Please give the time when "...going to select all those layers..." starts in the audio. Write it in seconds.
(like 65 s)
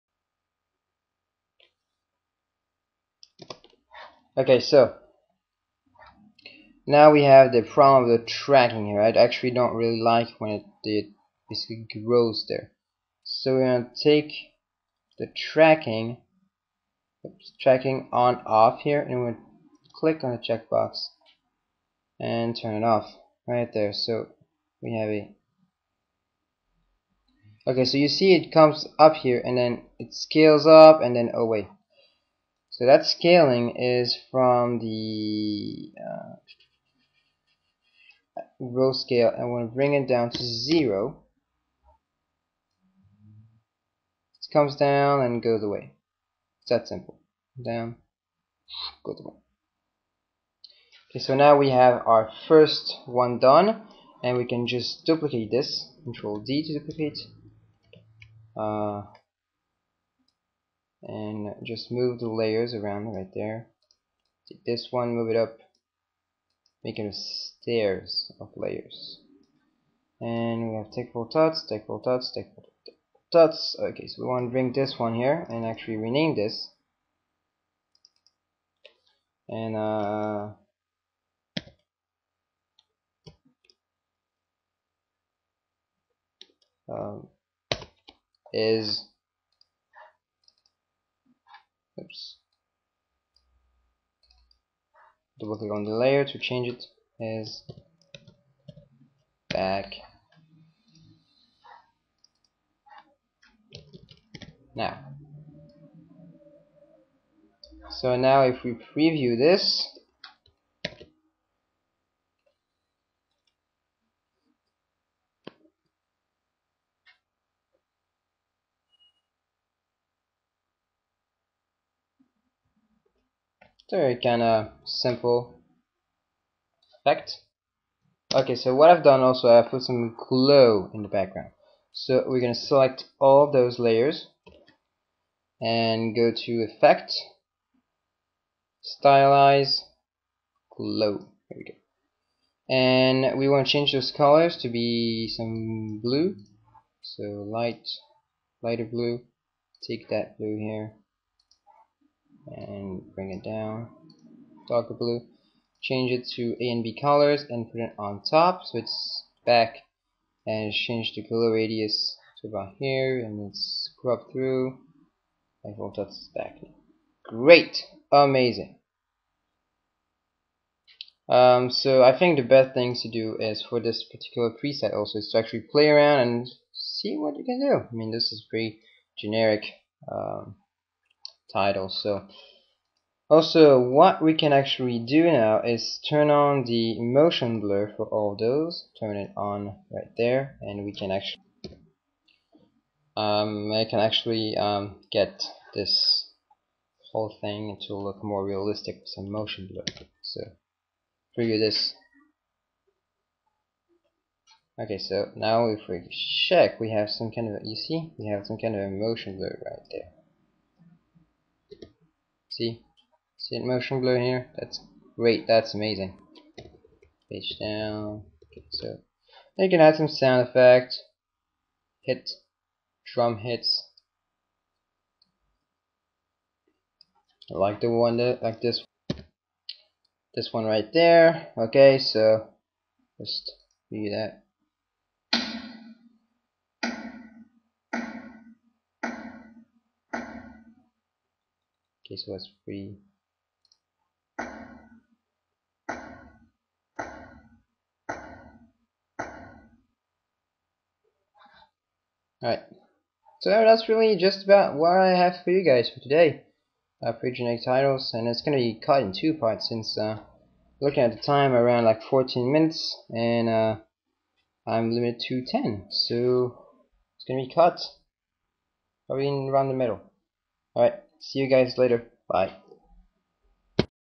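132 s.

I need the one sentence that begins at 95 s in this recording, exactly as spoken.
Double click on the layer to change it as back.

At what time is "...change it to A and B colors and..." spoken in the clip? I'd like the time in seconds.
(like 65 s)
155 s.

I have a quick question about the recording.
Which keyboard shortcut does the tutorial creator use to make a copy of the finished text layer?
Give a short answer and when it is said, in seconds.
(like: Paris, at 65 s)
Control D, at 56 s.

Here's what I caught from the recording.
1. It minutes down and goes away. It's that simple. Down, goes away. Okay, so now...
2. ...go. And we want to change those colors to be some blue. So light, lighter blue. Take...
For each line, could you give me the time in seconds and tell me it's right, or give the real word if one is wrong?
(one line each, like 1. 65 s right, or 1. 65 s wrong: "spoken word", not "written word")
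1. 44 s wrong: "comes", not "minutes"
2. 141 s right.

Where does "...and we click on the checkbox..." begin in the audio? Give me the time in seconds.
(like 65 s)
19 s.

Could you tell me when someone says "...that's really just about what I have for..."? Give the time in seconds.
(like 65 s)
253 s.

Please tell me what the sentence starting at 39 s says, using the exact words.
I want to bring it down to zero.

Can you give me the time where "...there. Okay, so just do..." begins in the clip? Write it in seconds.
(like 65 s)
230 s.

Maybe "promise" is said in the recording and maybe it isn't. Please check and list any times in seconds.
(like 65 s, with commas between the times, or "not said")
not said.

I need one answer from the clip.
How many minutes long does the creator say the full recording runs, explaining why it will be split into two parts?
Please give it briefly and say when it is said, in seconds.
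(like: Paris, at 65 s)
14, at 262 s.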